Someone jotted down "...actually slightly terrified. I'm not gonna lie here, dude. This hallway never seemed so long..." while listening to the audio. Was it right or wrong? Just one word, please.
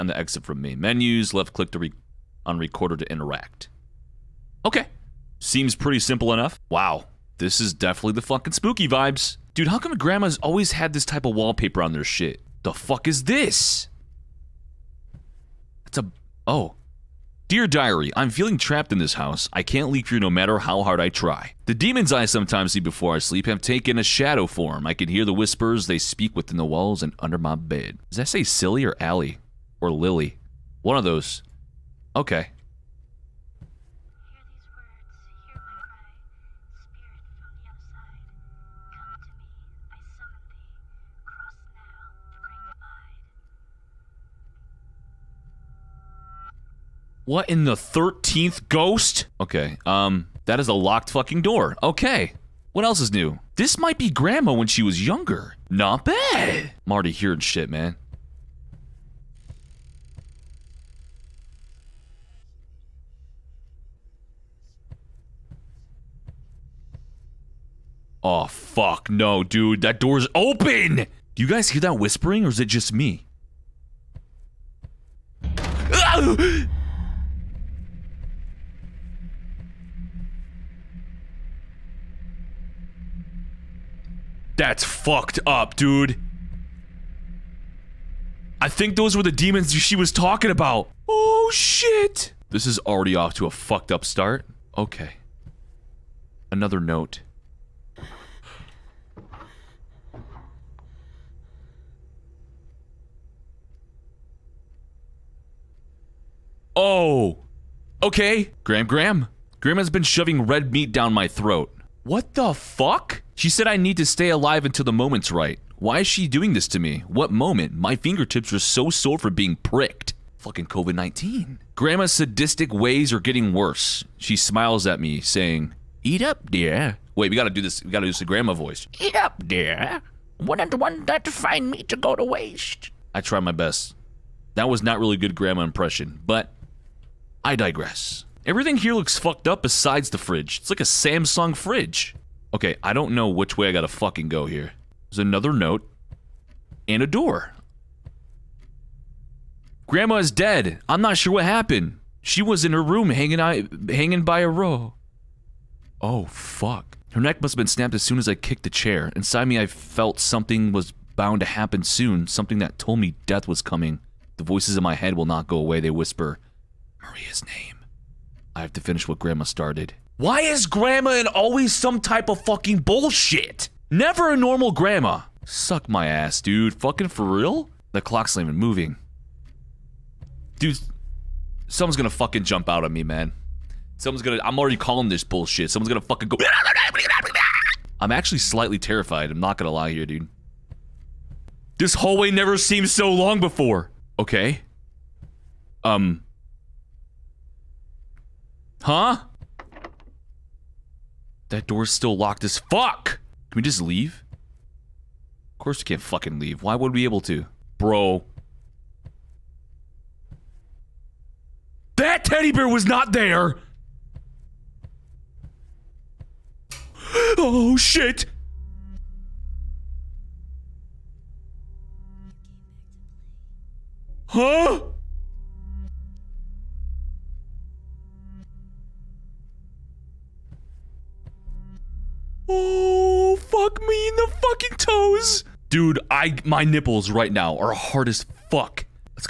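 right.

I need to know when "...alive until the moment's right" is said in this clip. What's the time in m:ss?
1:54.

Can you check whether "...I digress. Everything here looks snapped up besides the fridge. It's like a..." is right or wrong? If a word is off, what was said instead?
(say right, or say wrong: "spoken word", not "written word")
wrong: "fucked", not "snapped".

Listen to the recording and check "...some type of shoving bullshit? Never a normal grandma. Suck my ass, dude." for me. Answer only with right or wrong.
wrong.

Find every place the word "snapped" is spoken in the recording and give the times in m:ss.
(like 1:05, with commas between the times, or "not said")
2:37.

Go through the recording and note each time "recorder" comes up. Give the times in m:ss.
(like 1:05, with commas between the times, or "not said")
0:02.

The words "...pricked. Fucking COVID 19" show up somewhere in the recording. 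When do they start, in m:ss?
1:59.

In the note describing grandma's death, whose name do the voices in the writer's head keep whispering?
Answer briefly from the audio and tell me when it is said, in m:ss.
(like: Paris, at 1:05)
Maria, at 2:47.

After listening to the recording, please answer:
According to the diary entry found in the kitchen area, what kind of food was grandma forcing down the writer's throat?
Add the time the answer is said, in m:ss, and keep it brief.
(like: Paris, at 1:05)
red meat, at 1:50.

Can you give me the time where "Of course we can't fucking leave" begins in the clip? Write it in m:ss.
3:25.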